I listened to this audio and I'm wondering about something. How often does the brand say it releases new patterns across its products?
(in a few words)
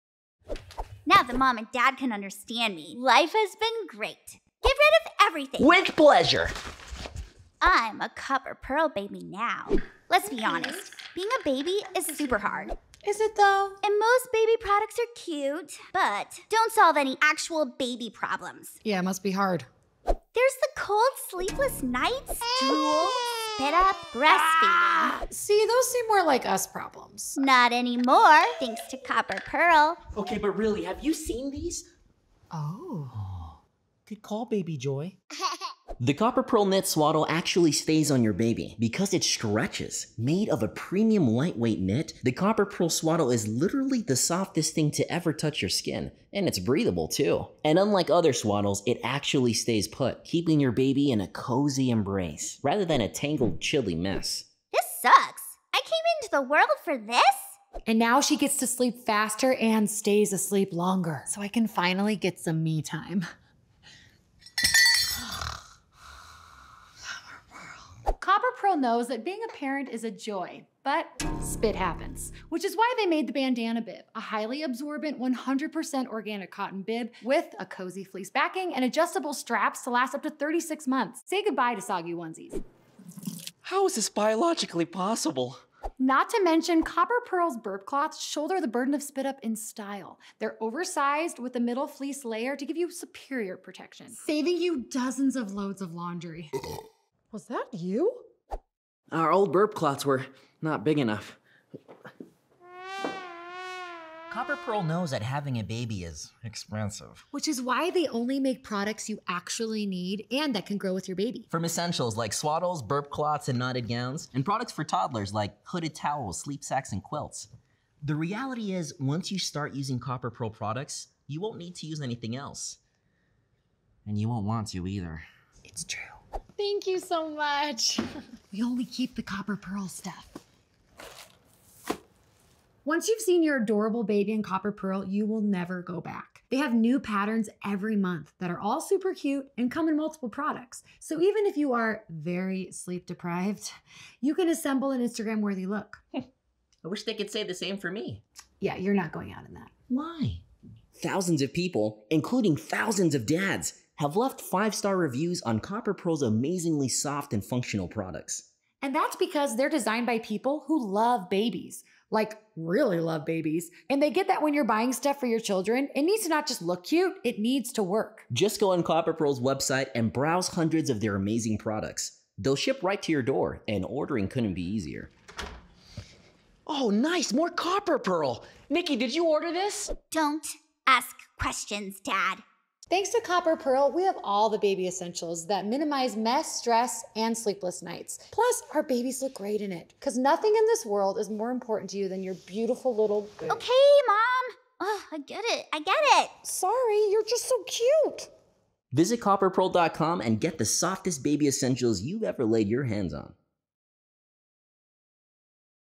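Every month.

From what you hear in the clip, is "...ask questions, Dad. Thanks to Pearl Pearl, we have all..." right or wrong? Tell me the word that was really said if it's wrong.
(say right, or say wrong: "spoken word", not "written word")
wrong: "Copper", not "Pearl".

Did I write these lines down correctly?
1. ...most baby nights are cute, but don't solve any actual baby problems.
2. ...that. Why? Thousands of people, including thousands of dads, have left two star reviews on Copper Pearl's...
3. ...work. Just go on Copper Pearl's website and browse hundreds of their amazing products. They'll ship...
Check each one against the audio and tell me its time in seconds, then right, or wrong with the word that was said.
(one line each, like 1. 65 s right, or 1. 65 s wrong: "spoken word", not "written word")
1. 13 s wrong: "products", not "nights"
2. 149 s wrong: "five", not "two"
3. 167 s right.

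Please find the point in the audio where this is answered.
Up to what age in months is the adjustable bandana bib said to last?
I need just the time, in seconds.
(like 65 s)
80 s.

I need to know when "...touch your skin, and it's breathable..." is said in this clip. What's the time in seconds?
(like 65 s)
45 s.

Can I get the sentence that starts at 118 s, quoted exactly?
The reality is, once you start using Copper Pearl products, you won't need to use anything else.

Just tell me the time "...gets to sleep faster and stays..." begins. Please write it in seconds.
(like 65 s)
58 s.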